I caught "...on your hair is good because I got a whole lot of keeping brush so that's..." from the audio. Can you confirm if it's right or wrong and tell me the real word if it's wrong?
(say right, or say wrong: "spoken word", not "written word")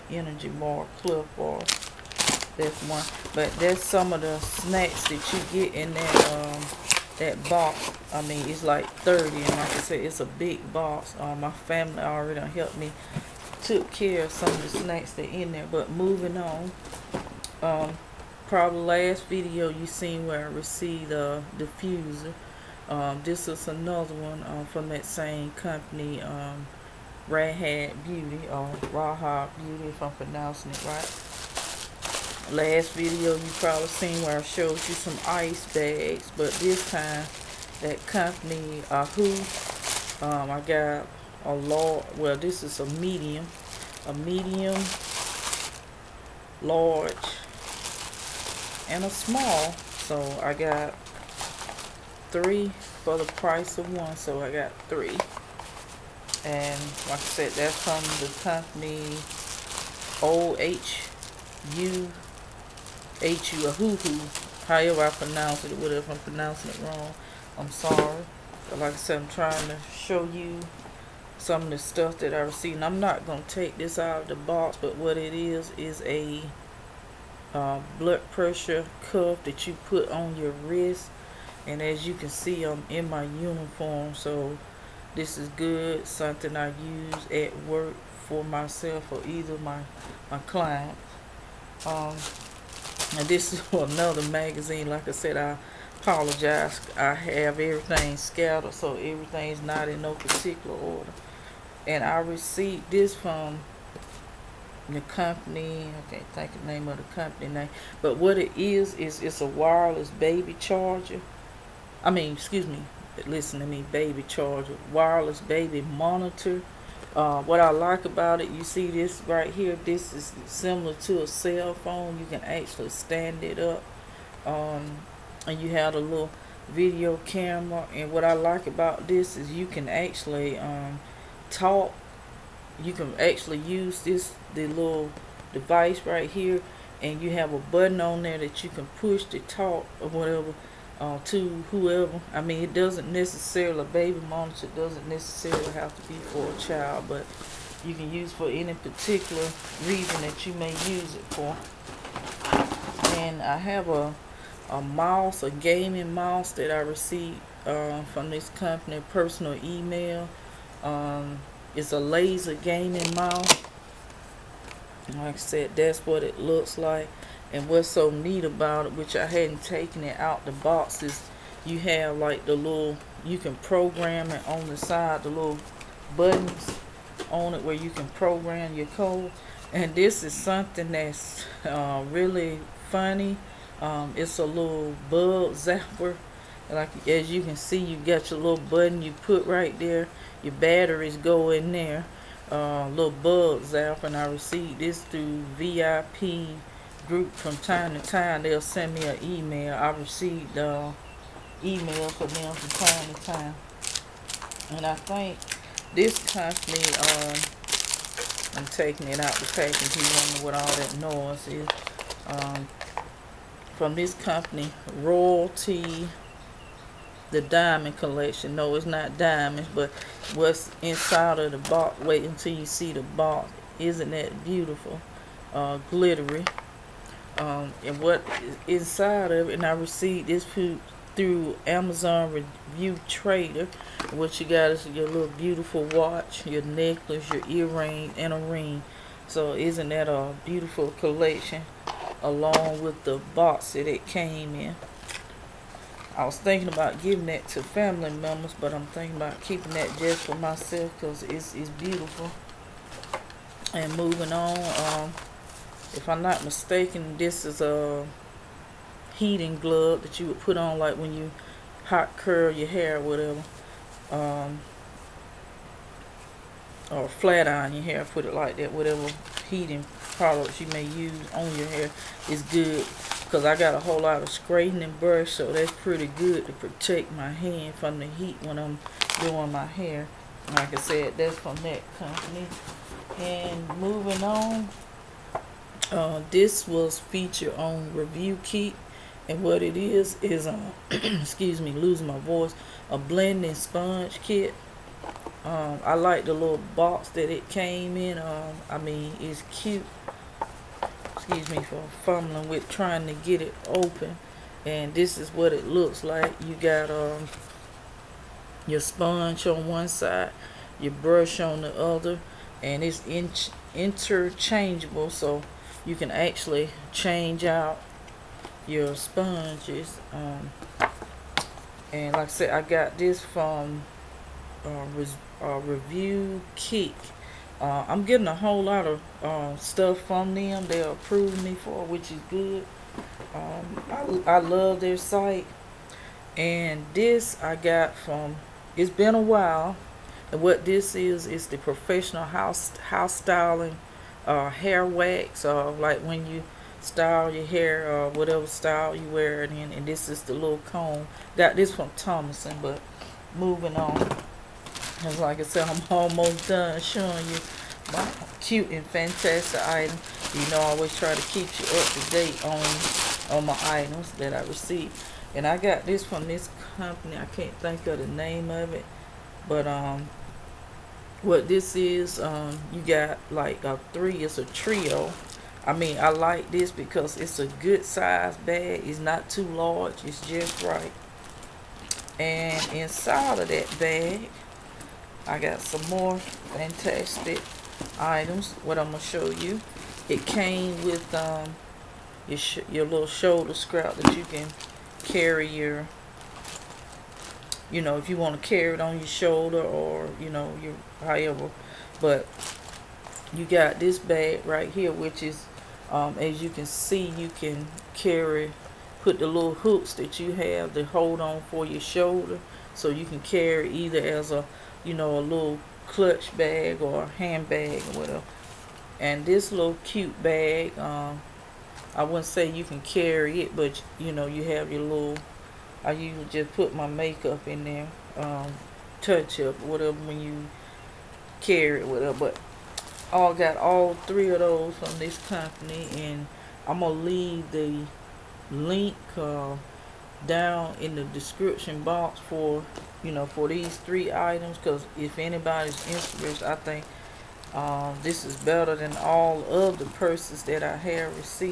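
wrong: "straightening", not "keeping".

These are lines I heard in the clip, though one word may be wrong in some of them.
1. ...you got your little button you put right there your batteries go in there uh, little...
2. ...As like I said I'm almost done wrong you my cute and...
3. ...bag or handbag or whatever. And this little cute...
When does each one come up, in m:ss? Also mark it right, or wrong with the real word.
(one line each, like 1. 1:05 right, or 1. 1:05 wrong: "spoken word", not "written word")
1. 3:07 right
2. 5:55 wrong: "showing", not "wrong"
3. 6:56 right.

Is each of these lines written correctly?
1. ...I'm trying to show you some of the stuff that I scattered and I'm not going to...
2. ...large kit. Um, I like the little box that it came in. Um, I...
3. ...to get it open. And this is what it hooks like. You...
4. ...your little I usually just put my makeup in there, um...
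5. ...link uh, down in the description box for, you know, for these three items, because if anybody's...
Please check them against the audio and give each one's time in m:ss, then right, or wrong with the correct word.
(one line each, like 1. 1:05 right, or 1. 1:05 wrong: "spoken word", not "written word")
1. 1:09 wrong: "received", not "scattered"
2. 4:53 wrong: "sponge", not "large"
3. 5:03 wrong: "looks", not "hooks"
4. 7:04 right
5. 7:18 right.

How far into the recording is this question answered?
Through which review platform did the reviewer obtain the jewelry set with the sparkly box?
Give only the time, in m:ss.
3:51.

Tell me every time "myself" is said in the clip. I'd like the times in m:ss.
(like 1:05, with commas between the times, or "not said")
1:28, 4:10.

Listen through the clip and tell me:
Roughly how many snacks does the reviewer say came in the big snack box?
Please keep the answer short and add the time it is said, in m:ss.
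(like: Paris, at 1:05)
30, at 0:09.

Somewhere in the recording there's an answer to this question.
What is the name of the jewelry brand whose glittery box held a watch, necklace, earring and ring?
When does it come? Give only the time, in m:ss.
3:35.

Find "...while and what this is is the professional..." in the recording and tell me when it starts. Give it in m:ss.
5:39.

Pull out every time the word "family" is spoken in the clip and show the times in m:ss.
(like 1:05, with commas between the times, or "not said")
0:11, 4:07.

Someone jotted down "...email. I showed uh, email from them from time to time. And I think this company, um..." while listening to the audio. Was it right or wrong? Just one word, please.
wrong.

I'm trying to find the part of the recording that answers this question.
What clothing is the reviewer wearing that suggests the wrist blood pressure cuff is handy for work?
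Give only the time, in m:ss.
1:23.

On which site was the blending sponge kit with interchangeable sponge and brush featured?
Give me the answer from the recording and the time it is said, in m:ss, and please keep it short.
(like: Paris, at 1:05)
Review Keep, at 4:47.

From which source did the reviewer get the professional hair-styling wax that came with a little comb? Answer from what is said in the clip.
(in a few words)
Thomason.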